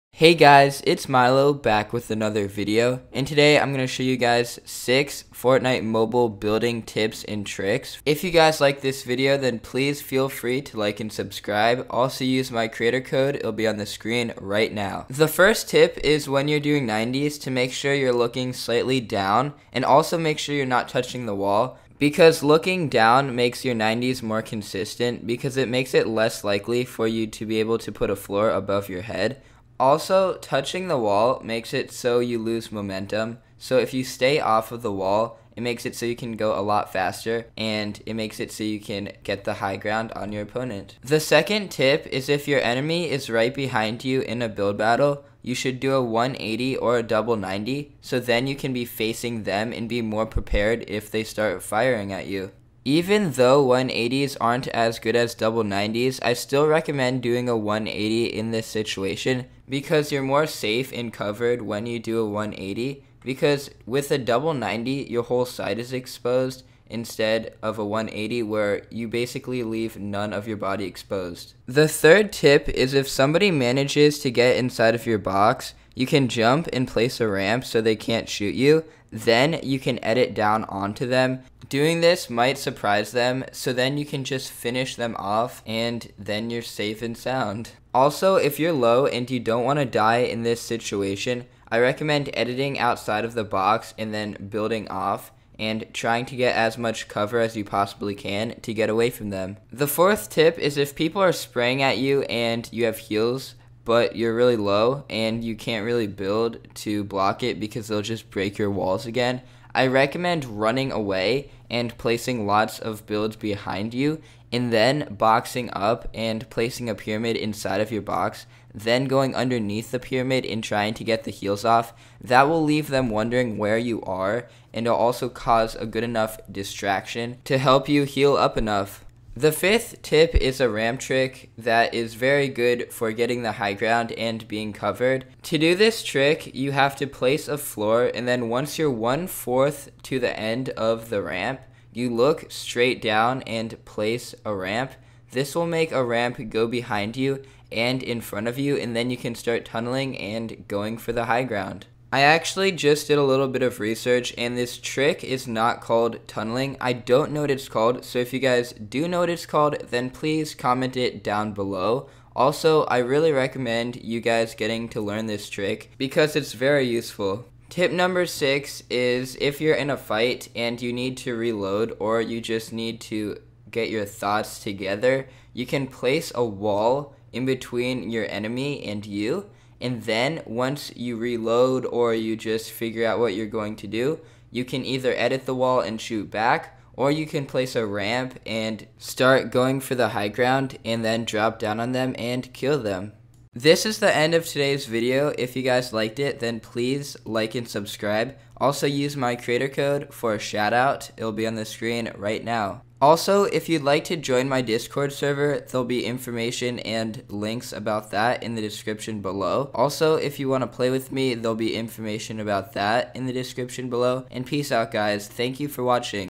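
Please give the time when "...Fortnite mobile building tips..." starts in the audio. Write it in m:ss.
0:05.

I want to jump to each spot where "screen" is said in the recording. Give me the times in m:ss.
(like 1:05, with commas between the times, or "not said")
0:13, 3:21.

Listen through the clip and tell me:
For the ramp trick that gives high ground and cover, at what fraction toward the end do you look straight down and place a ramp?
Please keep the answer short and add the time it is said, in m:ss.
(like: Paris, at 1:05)
One fourth, at 2:18.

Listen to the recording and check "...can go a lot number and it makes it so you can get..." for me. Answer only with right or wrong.
wrong.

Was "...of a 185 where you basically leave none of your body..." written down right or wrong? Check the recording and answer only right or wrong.
wrong.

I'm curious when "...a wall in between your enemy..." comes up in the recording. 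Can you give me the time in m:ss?
2:56.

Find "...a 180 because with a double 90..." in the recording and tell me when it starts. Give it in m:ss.
1:02.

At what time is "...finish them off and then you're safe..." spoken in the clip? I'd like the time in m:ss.
1:24.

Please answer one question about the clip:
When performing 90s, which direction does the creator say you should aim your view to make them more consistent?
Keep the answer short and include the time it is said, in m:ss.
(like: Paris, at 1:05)
Slightly down, at 0:18.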